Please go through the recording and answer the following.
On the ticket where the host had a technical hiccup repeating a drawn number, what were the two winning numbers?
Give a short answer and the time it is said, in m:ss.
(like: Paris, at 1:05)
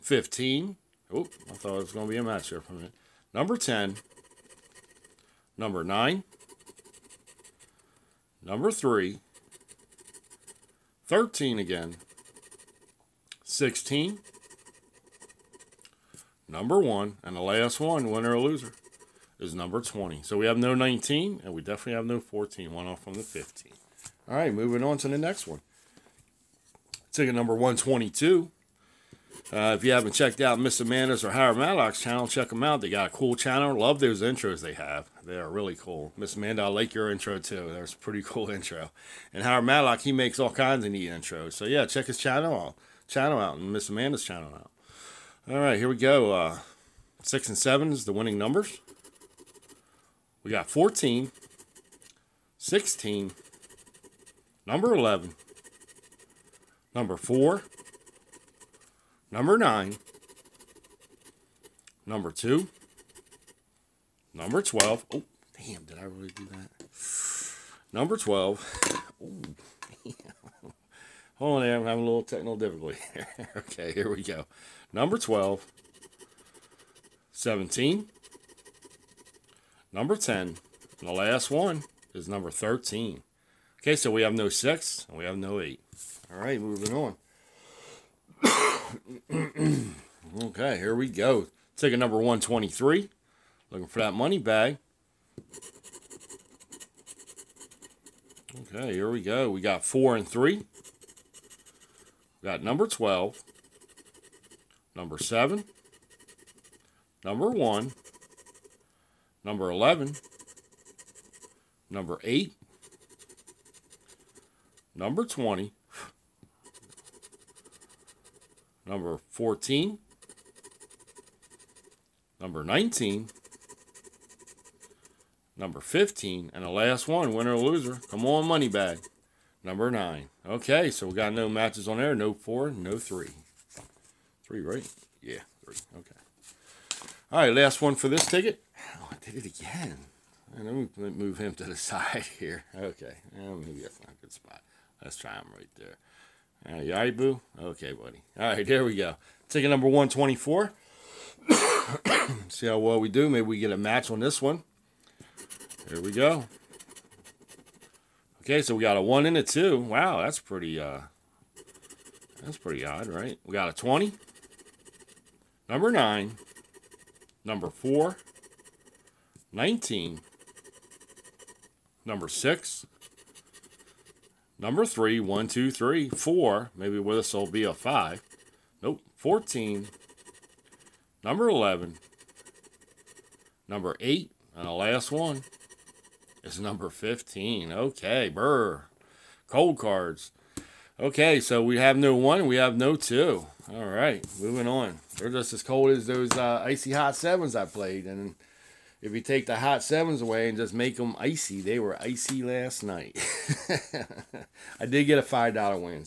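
6 and 7, at 0:47.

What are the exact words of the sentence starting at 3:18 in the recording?
And if you take the hot sevens away and just make them icy, they were icy last night.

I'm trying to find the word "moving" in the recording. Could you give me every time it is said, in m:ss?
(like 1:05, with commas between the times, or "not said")
0:24, 1:26, 3:14.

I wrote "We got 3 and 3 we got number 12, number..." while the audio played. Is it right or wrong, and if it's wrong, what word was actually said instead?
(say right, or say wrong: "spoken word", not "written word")
wrong: "4", not "3".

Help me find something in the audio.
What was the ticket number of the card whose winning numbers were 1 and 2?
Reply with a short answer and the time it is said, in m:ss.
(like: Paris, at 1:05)
124, at 2:29.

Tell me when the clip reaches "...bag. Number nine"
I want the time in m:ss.
2:08.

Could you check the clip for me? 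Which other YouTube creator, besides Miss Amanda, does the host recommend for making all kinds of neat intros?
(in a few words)
Howard Matlock.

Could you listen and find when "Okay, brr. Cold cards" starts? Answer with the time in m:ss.
3:07.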